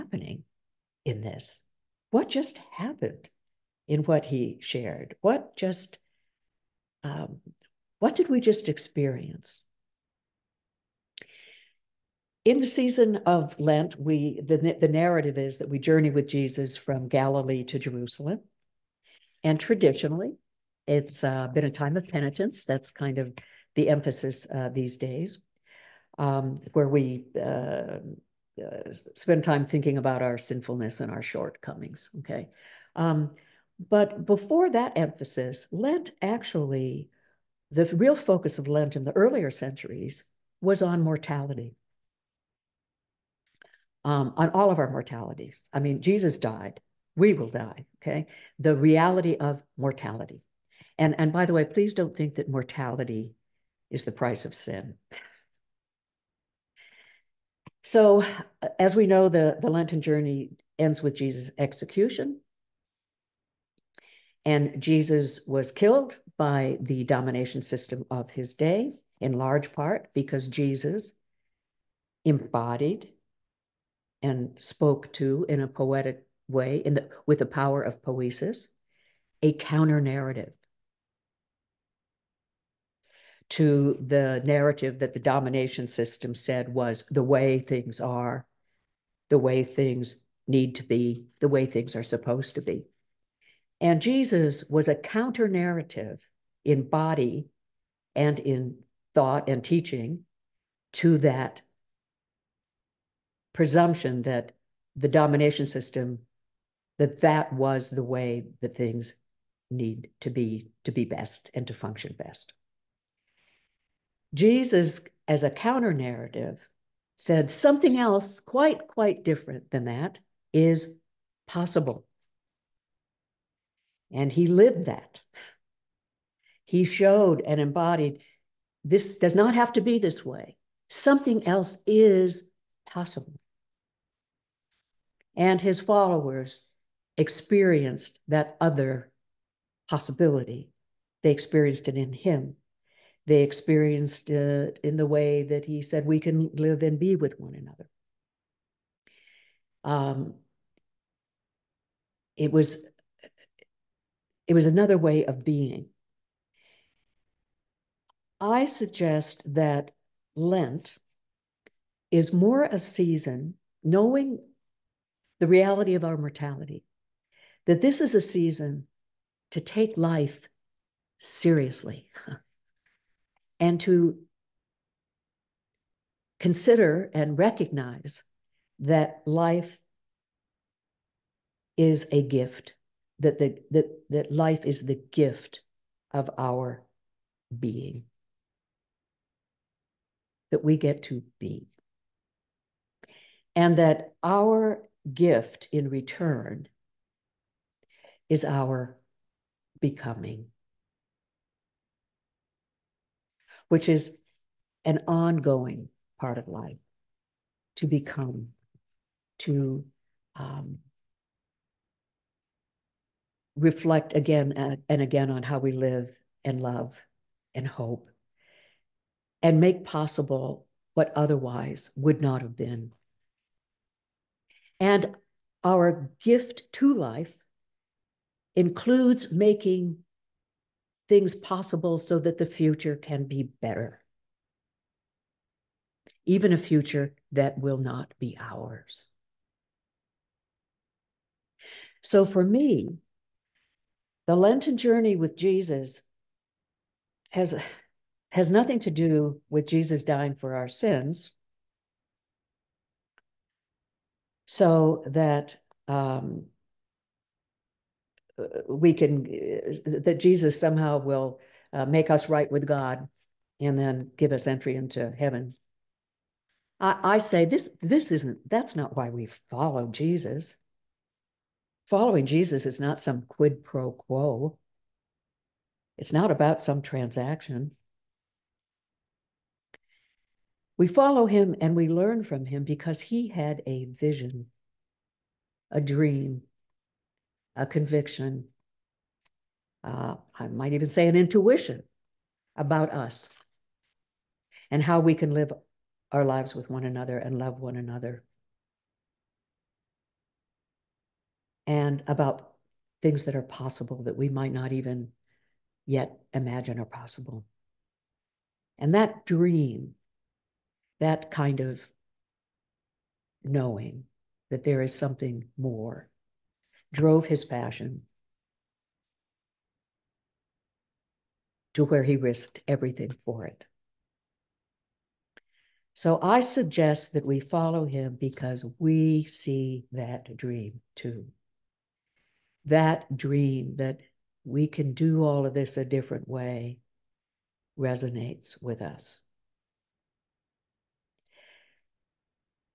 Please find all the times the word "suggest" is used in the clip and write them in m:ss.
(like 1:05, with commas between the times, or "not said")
2:38, 5:26.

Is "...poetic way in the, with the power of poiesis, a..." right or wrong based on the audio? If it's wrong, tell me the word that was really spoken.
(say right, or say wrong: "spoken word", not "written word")
right.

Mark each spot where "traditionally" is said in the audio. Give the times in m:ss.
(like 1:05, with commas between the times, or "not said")
0:19.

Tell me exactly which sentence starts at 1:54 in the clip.
Jesus, as a counter narrative, said something else quite, quite different than that is possible.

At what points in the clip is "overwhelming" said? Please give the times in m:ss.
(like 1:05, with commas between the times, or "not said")
not said.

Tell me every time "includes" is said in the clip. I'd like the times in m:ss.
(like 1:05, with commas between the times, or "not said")
3:48.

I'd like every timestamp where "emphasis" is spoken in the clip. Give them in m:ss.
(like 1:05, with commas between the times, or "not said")
0:23, 0:34.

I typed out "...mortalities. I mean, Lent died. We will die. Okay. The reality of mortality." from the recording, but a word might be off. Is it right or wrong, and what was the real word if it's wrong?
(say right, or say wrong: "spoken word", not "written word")
wrong: "Jesus", not "Lent".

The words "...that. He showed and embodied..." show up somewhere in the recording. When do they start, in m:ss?
2:04.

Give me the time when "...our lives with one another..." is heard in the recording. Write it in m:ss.
4:56.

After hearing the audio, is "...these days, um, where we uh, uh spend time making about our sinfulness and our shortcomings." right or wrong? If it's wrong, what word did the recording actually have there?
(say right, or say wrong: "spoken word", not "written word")
wrong: "thinking", not "making".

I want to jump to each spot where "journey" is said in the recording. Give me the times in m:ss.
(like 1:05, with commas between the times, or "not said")
0:15, 1:00, 4:04.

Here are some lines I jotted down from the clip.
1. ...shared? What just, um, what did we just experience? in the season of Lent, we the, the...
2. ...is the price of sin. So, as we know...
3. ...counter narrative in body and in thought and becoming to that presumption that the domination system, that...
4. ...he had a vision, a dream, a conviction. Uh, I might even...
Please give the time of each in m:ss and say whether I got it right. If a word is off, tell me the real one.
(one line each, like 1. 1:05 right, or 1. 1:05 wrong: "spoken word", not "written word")
1. 0:04 right
2. 0:53 right
3. 1:34 wrong: "teaching", not "becoming"
4. 4:42 right.